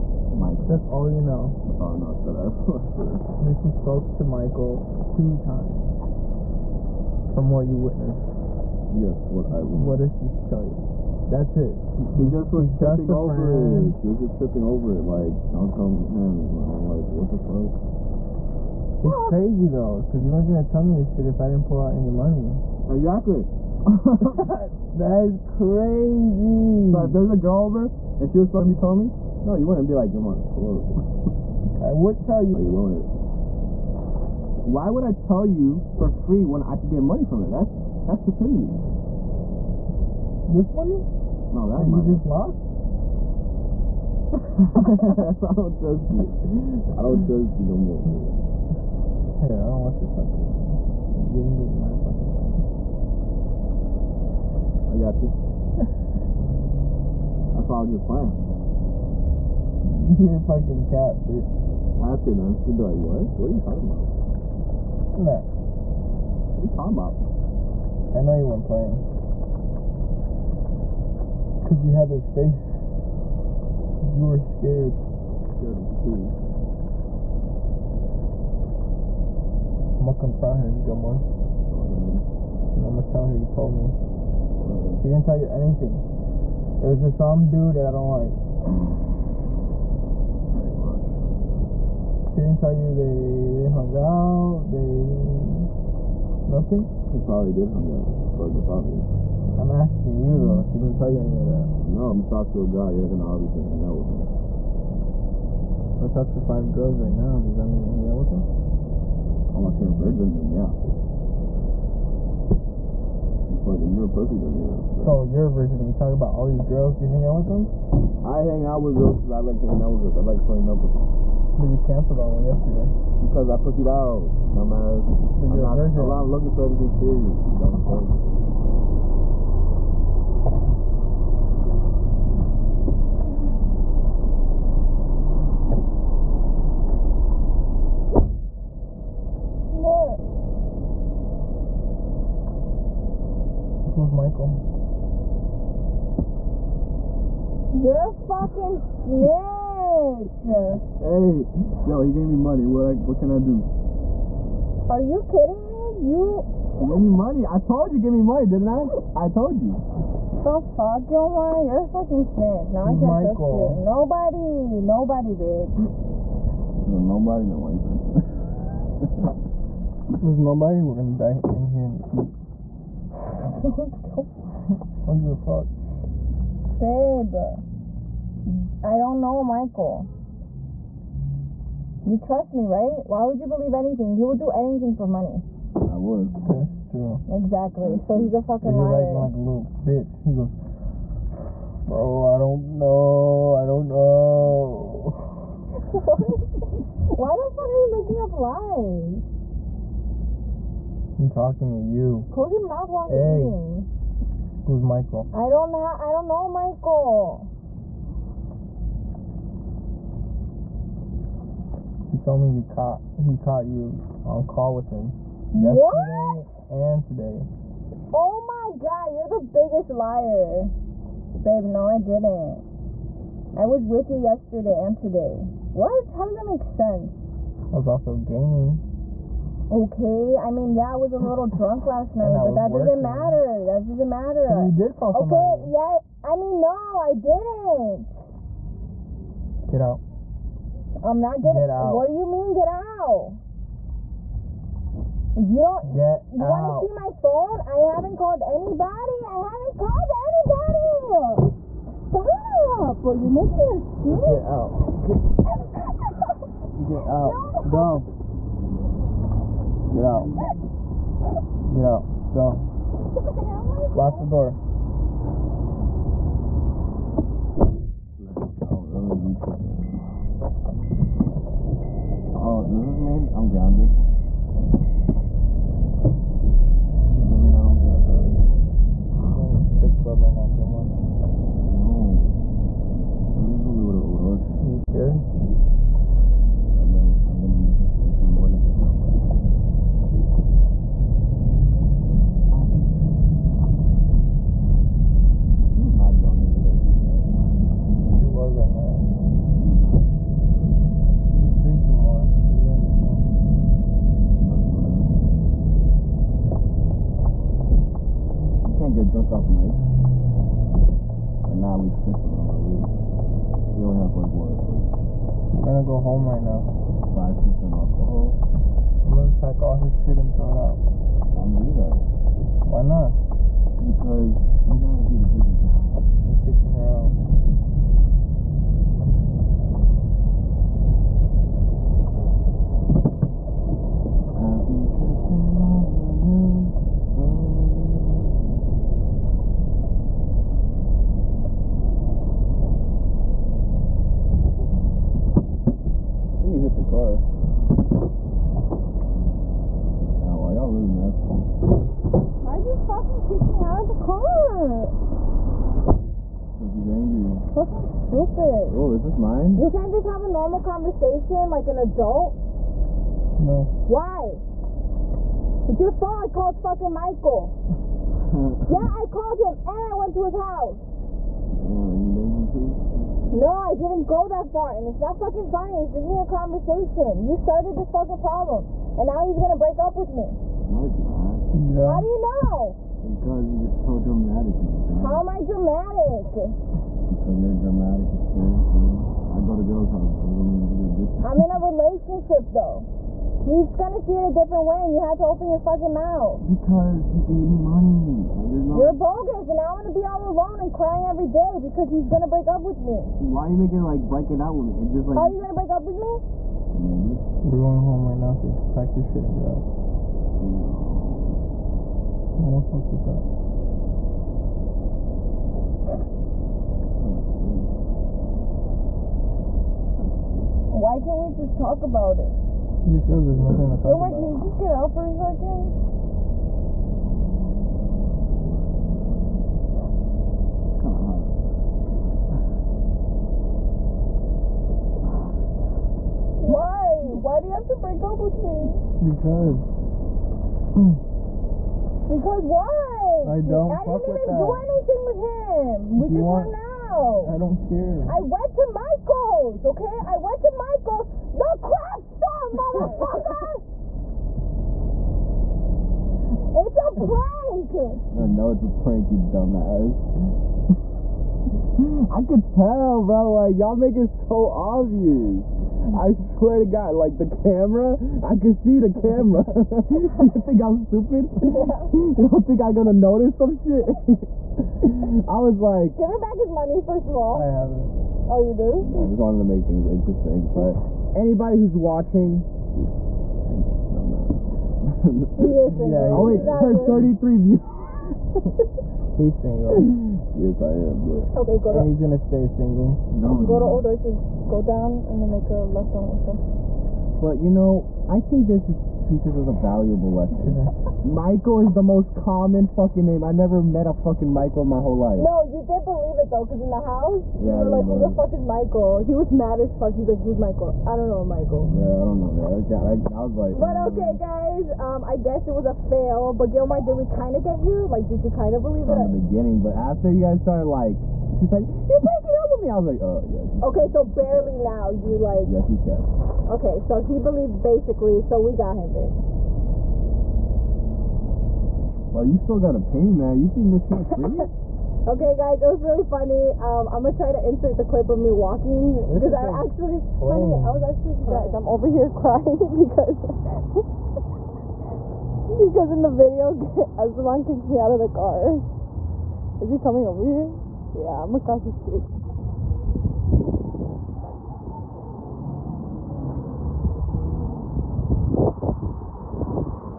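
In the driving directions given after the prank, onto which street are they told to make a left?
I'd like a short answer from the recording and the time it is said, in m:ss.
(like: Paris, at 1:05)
Wilson, at 8:16.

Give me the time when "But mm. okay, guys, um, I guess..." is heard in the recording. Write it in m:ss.
8:33.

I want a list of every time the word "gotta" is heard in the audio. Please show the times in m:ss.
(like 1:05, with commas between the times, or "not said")
5:24, 8:52.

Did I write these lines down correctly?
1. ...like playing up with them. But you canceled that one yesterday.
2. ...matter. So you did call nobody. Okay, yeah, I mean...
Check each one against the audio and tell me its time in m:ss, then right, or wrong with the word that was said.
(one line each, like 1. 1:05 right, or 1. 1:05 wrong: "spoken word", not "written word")
1. 2:00 right
2. 3:54 wrong: "somebody", not "nobody".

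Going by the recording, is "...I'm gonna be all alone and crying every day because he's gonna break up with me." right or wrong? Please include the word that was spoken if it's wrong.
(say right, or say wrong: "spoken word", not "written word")
right.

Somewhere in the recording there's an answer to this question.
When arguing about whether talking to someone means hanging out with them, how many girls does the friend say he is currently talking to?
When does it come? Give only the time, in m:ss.
1:46.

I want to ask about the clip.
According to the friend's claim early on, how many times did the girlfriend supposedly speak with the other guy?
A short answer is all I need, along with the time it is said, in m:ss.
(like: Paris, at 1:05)
2 times, at 0:05.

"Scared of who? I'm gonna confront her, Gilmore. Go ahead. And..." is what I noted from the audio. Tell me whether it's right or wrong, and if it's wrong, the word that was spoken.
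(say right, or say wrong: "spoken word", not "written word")
right.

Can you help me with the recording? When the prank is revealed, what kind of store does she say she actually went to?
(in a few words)
craft store.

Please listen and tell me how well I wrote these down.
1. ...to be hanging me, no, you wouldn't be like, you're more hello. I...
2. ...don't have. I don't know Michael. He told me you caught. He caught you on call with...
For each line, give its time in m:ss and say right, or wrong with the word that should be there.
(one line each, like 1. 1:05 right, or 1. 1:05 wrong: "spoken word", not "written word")
1. 0:28 wrong: "telling", not "hanging"
2. 3:25 right.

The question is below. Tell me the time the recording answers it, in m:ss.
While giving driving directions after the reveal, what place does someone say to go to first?
8:13.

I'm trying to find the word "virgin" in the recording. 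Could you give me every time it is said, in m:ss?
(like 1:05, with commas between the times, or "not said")
1:49, 1:55, 2:05.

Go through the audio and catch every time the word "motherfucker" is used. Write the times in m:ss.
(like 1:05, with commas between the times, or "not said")
7:32.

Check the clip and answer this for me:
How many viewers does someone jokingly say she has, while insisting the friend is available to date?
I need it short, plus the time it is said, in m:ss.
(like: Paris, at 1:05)
33, at 8:06.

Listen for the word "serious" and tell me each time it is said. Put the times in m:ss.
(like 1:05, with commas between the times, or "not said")
2:06.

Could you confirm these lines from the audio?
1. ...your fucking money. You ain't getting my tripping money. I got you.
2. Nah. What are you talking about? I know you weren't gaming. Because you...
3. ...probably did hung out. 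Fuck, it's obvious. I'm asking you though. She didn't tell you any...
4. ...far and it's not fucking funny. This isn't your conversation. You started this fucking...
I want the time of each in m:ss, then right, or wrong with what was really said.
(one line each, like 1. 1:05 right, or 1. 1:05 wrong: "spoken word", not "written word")
1. 0:49 wrong: "fucking", not "tripping"
2. 1:05 wrong: "playing", not "gaming"
3. 1:37 right
4. 6:14 right.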